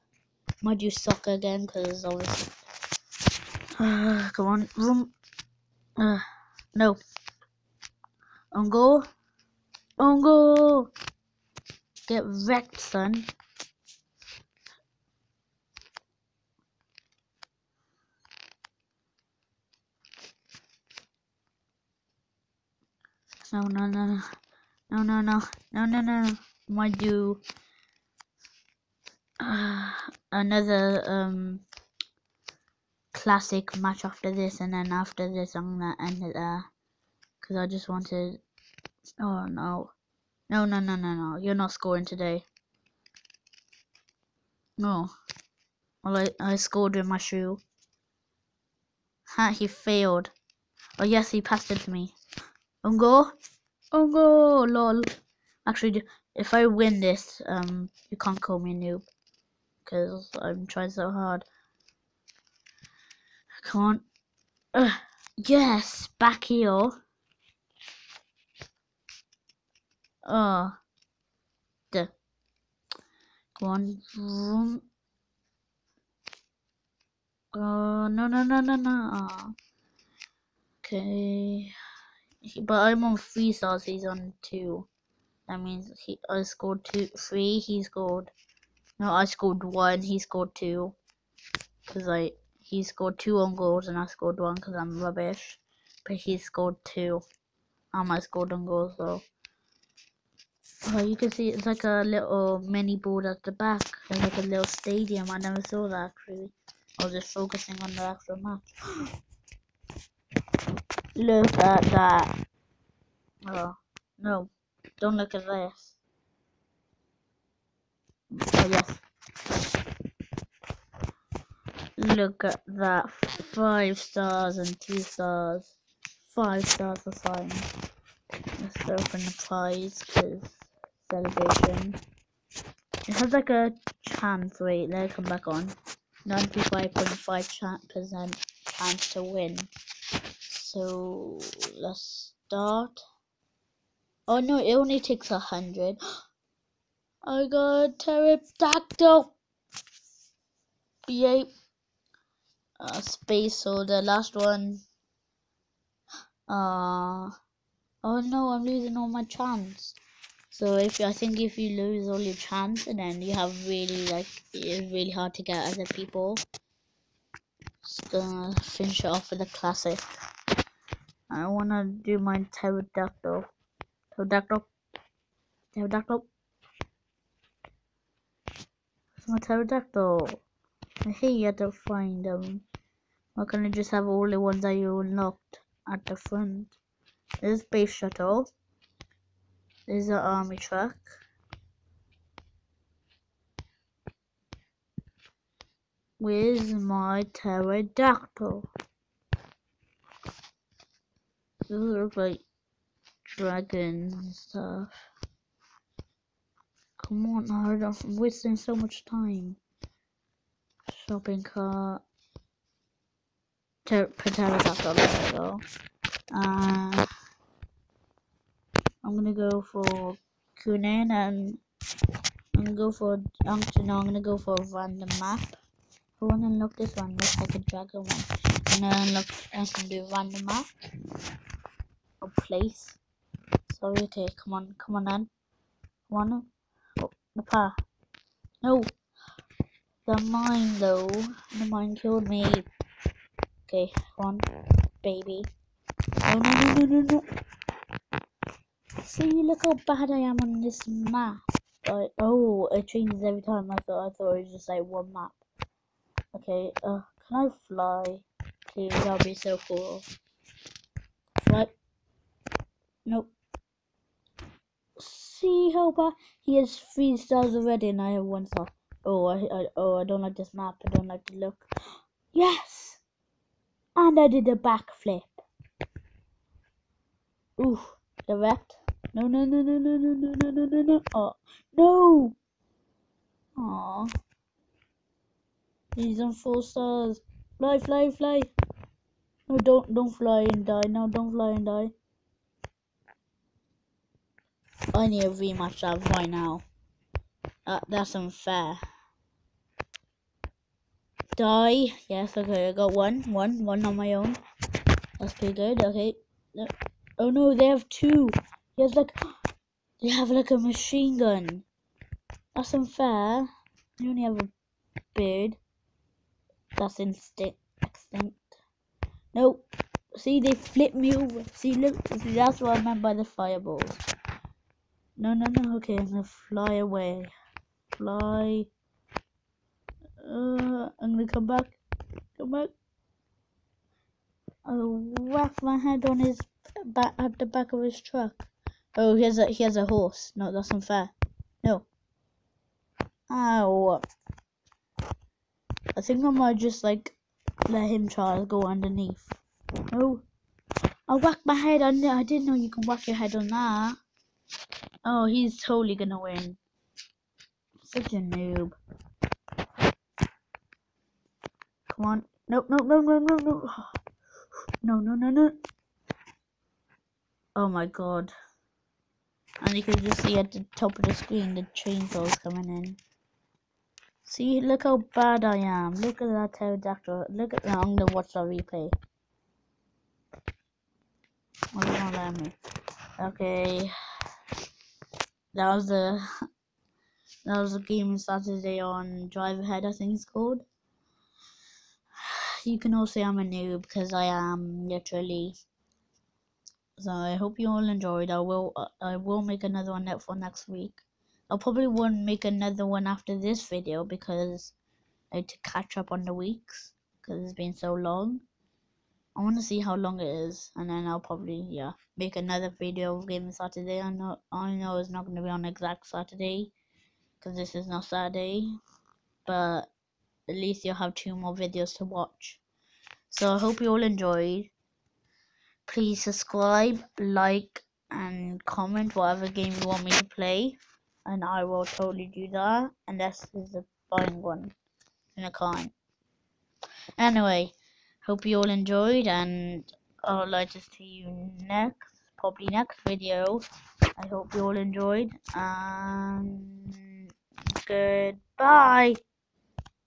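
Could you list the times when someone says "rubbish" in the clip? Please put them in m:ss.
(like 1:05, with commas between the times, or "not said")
1:35.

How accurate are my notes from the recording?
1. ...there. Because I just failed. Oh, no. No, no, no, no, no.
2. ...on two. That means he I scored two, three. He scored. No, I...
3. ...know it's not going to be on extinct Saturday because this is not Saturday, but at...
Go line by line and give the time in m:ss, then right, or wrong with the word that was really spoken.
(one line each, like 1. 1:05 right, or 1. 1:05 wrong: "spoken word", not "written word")
1. 0:36 wrong: "wanted", not "failed"
2. 1:24 right
3. 6:54 wrong: "exact", not "extinct".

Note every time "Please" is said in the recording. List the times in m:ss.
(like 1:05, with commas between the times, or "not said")
4:18, 7:05.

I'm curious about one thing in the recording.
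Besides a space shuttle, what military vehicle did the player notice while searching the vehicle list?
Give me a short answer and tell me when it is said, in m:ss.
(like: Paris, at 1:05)
Army truck, at 3:10.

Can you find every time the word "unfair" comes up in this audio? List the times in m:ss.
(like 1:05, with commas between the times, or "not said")
4:58, 5:12, 5:40.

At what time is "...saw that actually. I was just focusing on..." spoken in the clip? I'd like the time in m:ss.
1:45.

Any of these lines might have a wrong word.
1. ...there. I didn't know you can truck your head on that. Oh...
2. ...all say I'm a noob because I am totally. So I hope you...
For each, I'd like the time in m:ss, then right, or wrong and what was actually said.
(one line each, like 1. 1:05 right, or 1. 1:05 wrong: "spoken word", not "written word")
1. 5:52 wrong: "whack", not "truck"
2. 6:32 wrong: "literally", not "totally".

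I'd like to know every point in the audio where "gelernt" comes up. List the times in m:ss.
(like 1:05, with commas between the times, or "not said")
not said.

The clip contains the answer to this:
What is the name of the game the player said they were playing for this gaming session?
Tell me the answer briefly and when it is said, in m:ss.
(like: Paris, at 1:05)
Drive Ahead, at 6:29.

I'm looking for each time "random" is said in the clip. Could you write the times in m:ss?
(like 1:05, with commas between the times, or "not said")
3:44, 3:50.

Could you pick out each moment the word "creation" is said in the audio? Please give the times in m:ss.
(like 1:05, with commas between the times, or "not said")
not said.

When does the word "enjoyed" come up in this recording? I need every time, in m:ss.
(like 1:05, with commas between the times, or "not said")
6:37, 7:04, 7:18, 7:24.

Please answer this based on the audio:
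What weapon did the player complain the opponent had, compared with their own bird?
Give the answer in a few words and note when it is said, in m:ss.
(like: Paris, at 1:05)
Machine gun, at 5:10.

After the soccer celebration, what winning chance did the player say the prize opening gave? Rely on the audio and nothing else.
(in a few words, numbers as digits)
95.5%.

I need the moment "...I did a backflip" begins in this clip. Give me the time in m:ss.
4:34.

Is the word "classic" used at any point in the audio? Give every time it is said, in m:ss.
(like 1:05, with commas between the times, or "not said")
0:33, 2:49.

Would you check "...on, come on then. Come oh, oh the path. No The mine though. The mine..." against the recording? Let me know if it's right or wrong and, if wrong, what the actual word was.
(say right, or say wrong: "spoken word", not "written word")
right.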